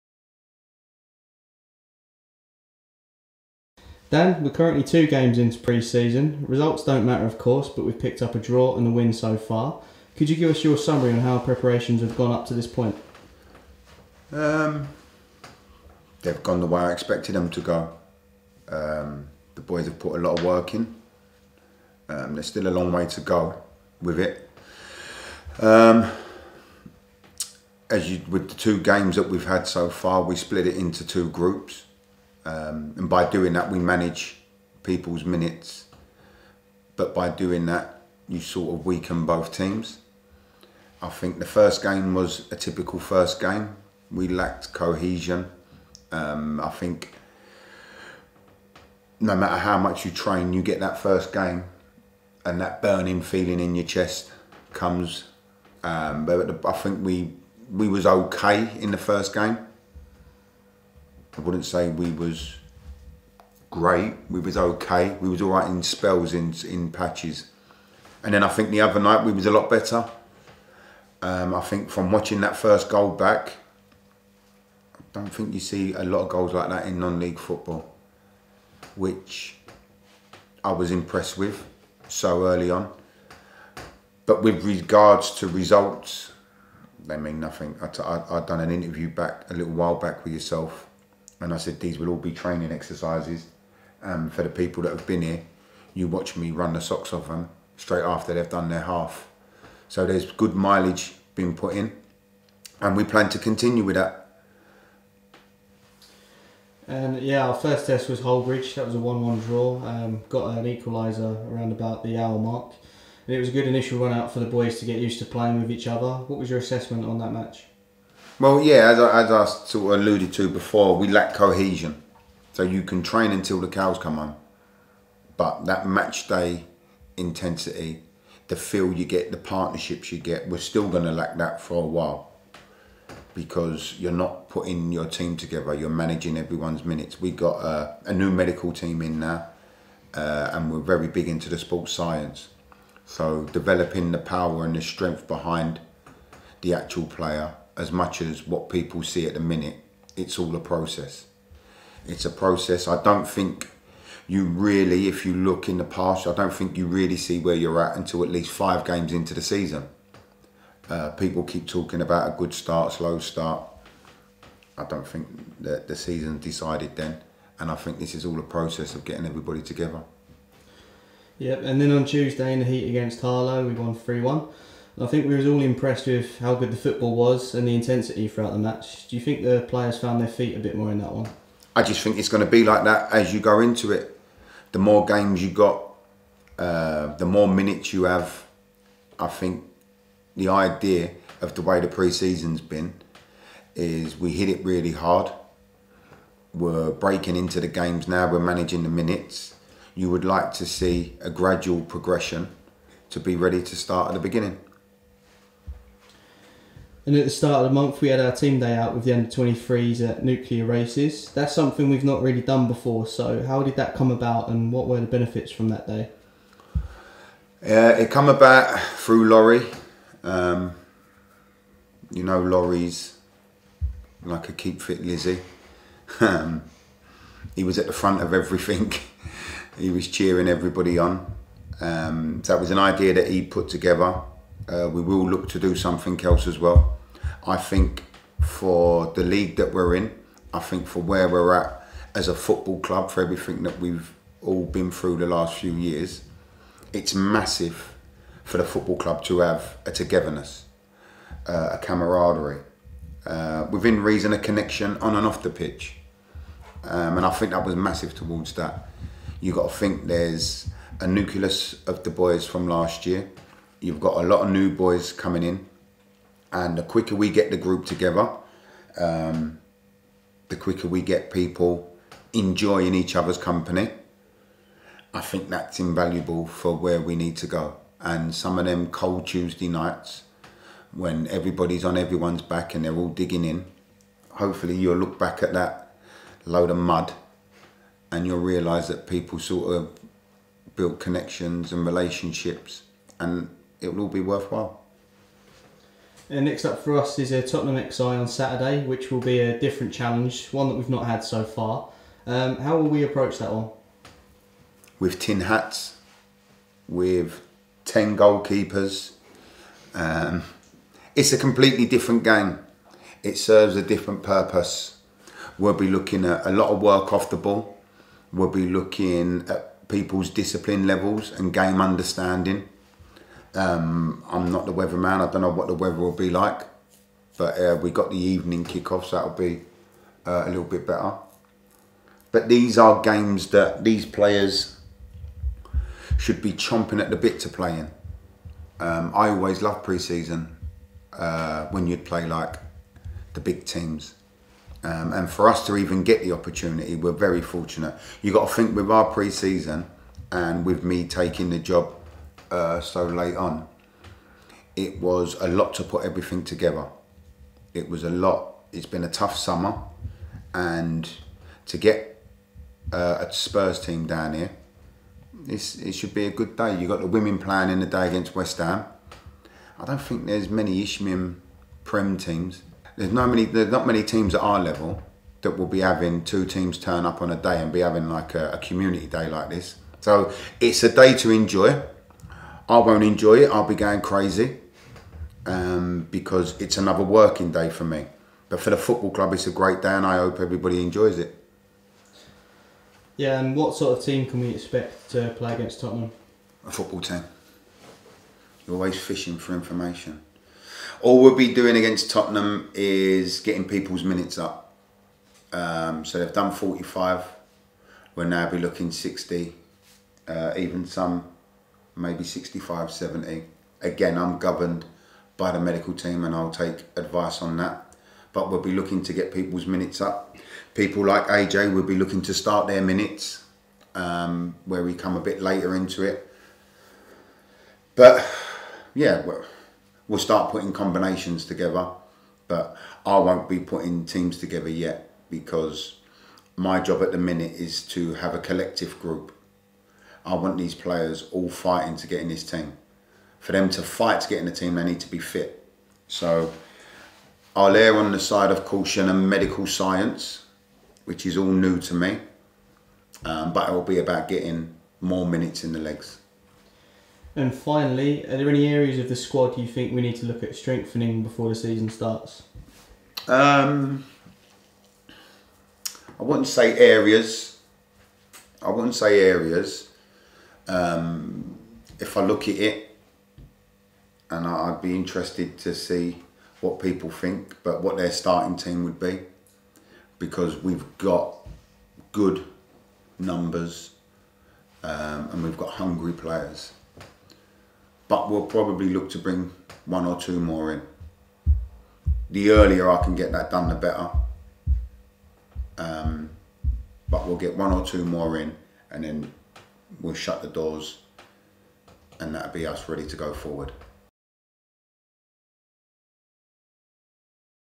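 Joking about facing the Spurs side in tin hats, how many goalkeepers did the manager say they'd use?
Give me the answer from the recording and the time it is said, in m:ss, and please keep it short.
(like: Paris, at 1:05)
10, at 5:07.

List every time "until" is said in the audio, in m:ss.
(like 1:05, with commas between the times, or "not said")
2:03, 2:37.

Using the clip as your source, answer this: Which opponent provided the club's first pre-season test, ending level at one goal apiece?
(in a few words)
Hullbridge.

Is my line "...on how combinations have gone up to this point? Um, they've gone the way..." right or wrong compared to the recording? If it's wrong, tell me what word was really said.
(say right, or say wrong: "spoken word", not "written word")
wrong: "preparations", not "combinations".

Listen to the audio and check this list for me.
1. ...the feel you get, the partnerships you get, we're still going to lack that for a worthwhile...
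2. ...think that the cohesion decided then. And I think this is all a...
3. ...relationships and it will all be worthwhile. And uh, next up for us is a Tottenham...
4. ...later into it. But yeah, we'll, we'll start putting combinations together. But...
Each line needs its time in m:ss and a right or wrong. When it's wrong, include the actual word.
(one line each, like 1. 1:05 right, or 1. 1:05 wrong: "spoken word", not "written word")
1. 2:08 wrong: "while", not "worthwhile"
2. 2:45 wrong: "season", not "cohesion"
3. 4:51 right
4. 7:05 right.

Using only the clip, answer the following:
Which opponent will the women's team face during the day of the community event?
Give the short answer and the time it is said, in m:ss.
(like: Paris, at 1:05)
West Ham, at 6:08.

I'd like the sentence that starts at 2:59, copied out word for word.
Do you think the players found their feet a bit more in that one?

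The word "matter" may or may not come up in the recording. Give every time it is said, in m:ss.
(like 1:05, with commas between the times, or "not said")
0:07, 0:49.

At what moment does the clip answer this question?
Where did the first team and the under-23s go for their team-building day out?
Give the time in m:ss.
3:30.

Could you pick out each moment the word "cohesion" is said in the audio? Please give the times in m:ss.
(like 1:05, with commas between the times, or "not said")
0:44, 2:01.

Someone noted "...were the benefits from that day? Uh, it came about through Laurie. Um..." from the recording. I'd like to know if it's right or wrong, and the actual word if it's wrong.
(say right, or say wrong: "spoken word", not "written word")
right.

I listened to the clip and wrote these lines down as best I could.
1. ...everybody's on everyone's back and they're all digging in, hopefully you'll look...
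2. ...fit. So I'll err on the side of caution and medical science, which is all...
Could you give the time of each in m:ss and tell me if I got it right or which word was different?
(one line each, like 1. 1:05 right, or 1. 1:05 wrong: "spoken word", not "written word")
1. 4:41 right
2. 7:25 right.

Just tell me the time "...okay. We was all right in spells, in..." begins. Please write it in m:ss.
1:04.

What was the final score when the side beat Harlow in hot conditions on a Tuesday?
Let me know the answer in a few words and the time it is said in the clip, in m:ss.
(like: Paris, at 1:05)
3-1, at 2:53.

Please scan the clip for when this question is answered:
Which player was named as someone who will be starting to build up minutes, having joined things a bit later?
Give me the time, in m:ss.
7:01.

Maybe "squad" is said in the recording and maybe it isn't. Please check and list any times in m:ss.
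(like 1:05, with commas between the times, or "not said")
7:39.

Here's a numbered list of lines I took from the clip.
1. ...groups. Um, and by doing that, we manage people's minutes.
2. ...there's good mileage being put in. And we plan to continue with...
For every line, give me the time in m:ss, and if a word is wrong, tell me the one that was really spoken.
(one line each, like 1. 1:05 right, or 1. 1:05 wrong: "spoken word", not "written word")
1. 0:31 right
2. 1:40 right.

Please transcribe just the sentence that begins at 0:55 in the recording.
Um, but I think we we was okay in the first game.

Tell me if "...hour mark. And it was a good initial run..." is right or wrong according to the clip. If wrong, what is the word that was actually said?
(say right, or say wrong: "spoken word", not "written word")
right.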